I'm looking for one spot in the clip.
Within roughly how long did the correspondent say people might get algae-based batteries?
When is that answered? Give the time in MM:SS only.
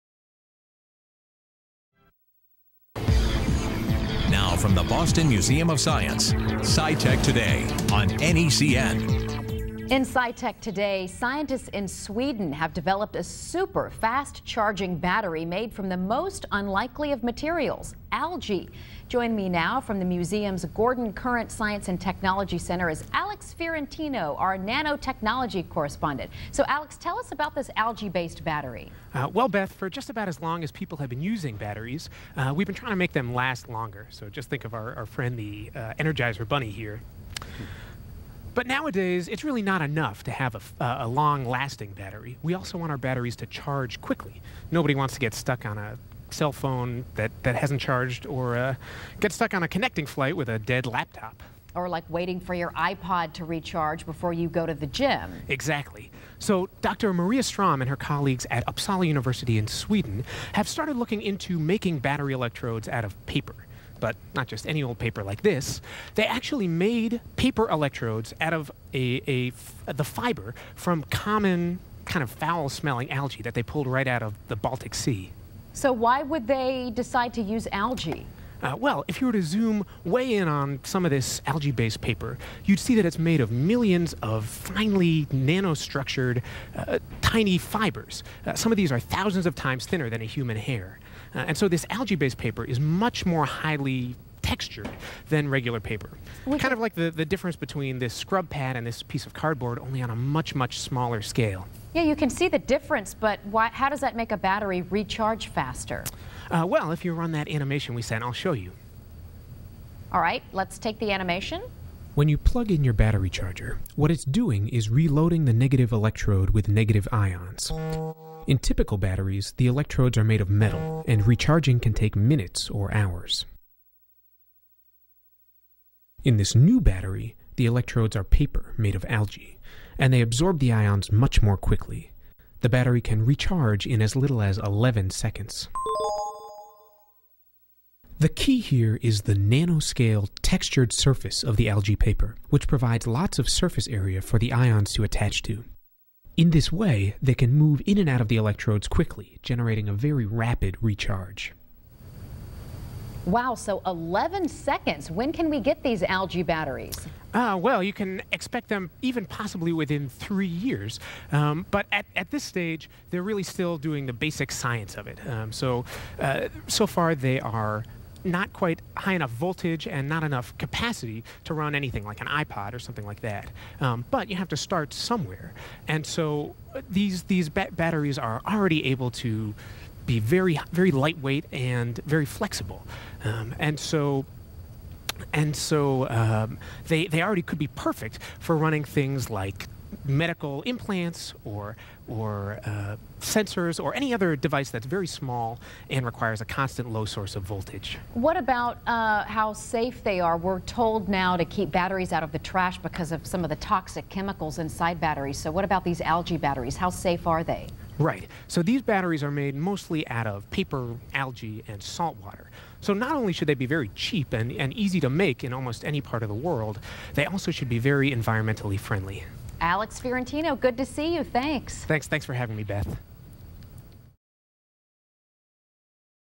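02:40.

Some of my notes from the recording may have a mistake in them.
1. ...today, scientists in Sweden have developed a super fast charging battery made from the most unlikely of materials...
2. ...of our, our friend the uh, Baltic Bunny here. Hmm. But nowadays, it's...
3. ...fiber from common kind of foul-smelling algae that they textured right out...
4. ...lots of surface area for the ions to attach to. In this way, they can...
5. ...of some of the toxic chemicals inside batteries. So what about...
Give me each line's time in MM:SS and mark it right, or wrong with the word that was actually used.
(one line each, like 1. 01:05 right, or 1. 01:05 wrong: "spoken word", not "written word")
1. 00:10 right
2. 00:34 wrong: "Energizer", not "Baltic"
3. 01:10 wrong: "pulled", not "textured"
4. 02:23 right
5. 03:23 right.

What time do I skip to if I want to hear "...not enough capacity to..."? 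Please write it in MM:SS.
02:50.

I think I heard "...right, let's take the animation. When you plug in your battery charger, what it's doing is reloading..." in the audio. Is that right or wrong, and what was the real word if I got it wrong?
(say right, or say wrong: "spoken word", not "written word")
right.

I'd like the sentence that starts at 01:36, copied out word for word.
kind of like the, the difference between this scrub pad and this piece of cardboard, only on a much, much smaller scale.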